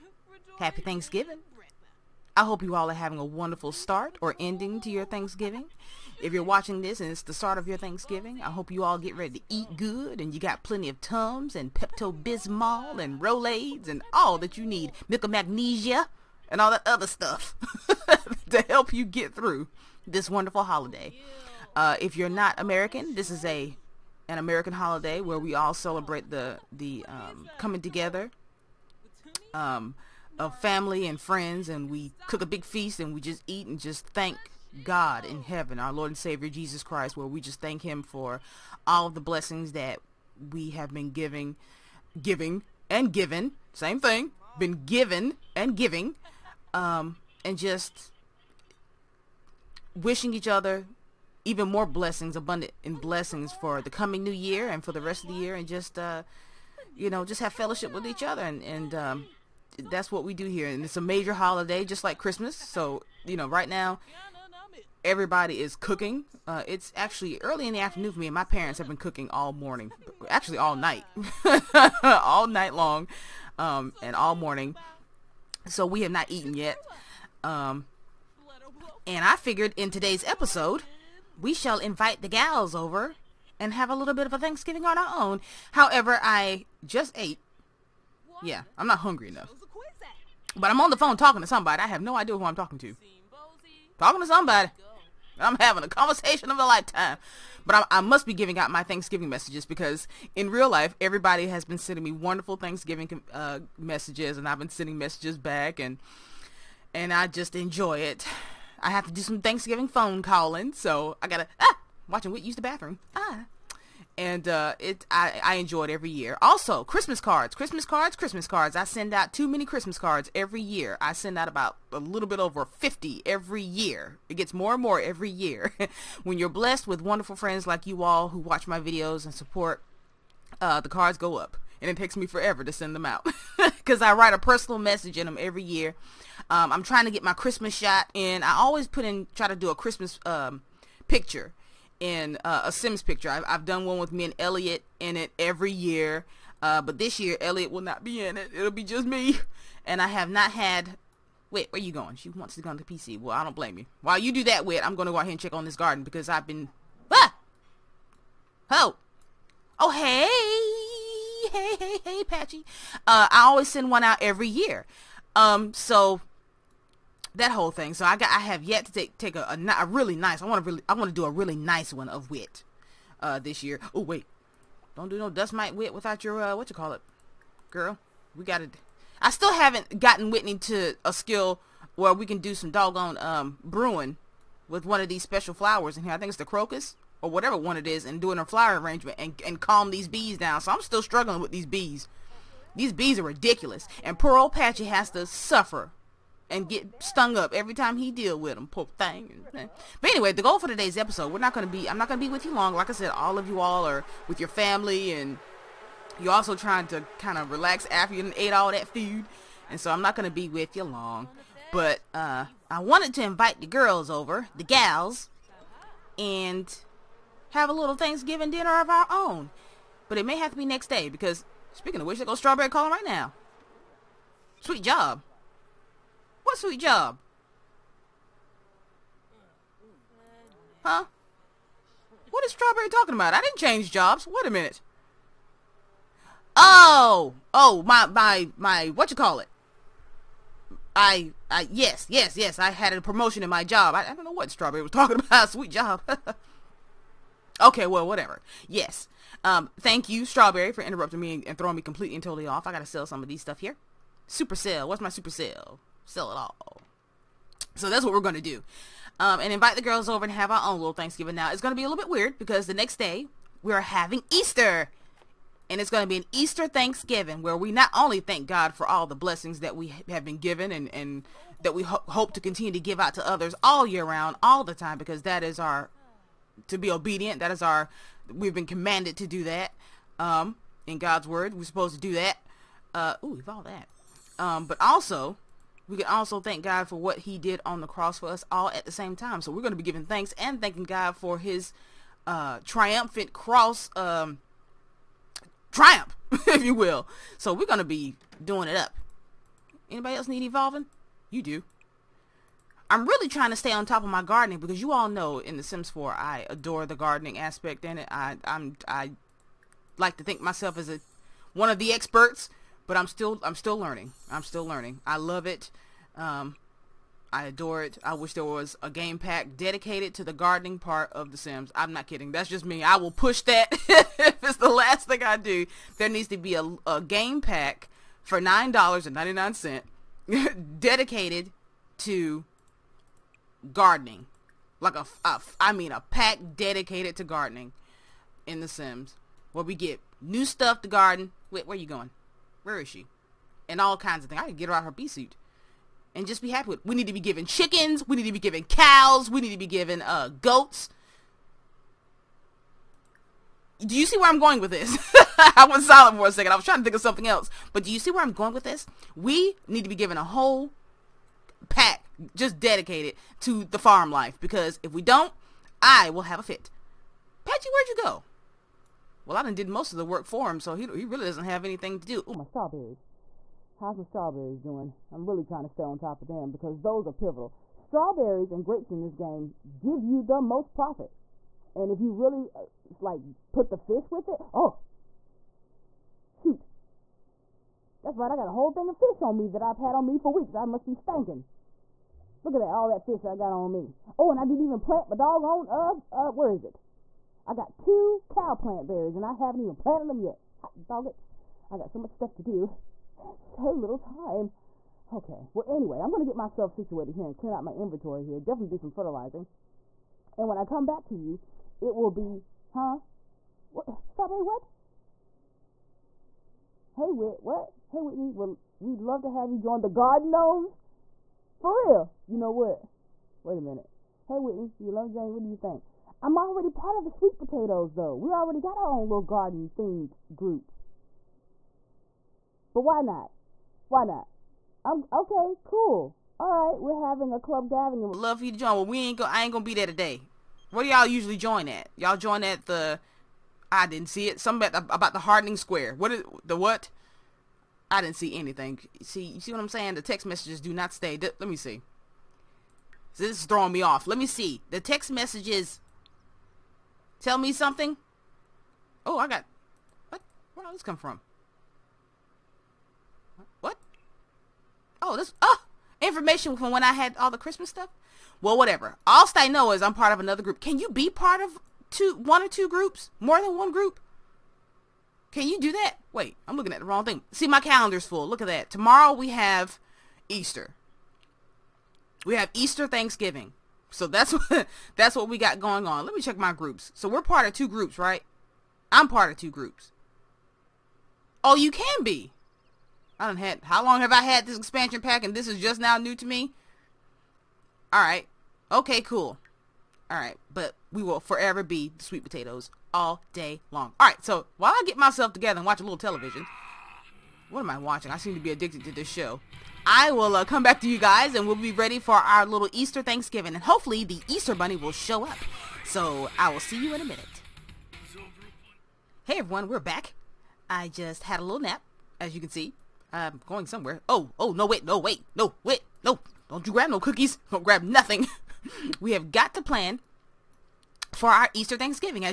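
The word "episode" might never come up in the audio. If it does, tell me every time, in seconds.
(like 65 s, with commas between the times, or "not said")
80 s, 200 s.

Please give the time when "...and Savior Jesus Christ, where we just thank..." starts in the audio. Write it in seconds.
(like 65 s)
36 s.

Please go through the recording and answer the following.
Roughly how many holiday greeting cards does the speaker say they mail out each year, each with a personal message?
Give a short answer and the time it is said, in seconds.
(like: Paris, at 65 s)
a little over 50, at 121 s.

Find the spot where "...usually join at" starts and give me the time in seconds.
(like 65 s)
441 s.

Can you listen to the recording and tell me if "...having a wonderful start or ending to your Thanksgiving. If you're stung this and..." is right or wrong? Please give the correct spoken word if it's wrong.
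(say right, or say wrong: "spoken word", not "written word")
wrong: "watching", not "stung".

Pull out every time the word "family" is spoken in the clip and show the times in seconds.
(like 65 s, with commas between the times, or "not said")
30 s, 204 s.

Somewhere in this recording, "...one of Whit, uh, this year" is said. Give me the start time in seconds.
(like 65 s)
171 s.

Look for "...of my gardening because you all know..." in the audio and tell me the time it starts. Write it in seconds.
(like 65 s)
304 s.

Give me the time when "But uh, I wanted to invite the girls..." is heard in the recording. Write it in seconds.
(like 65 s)
211 s.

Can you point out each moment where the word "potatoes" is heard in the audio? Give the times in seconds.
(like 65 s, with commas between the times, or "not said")
427 s, 502 s.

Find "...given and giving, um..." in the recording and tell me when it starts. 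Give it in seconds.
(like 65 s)
44 s.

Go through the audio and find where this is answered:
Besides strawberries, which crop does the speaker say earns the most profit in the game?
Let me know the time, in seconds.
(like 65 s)
378 s.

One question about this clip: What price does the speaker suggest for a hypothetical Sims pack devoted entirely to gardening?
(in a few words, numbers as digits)
$9.99.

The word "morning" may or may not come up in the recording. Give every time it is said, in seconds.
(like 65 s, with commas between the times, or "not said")
69 s, 74 s.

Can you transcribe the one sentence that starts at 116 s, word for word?
Also, Christmas cards, Christmas cards, Christmas cards.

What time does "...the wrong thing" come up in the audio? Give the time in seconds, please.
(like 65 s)
476 s.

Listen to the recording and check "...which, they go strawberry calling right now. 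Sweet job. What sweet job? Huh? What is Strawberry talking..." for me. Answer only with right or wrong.
right.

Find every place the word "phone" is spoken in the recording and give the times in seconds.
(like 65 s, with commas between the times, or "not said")
90 s, 109 s.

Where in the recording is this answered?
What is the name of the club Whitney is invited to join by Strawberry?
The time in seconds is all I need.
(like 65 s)
419 s.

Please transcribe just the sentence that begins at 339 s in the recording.
Where we get new stuff to garden.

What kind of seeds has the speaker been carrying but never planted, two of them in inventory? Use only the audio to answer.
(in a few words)
cow plant berries.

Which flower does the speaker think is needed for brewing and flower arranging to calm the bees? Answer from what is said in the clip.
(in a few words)
crocus.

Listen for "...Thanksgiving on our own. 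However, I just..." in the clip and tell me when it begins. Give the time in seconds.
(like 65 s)
84 s.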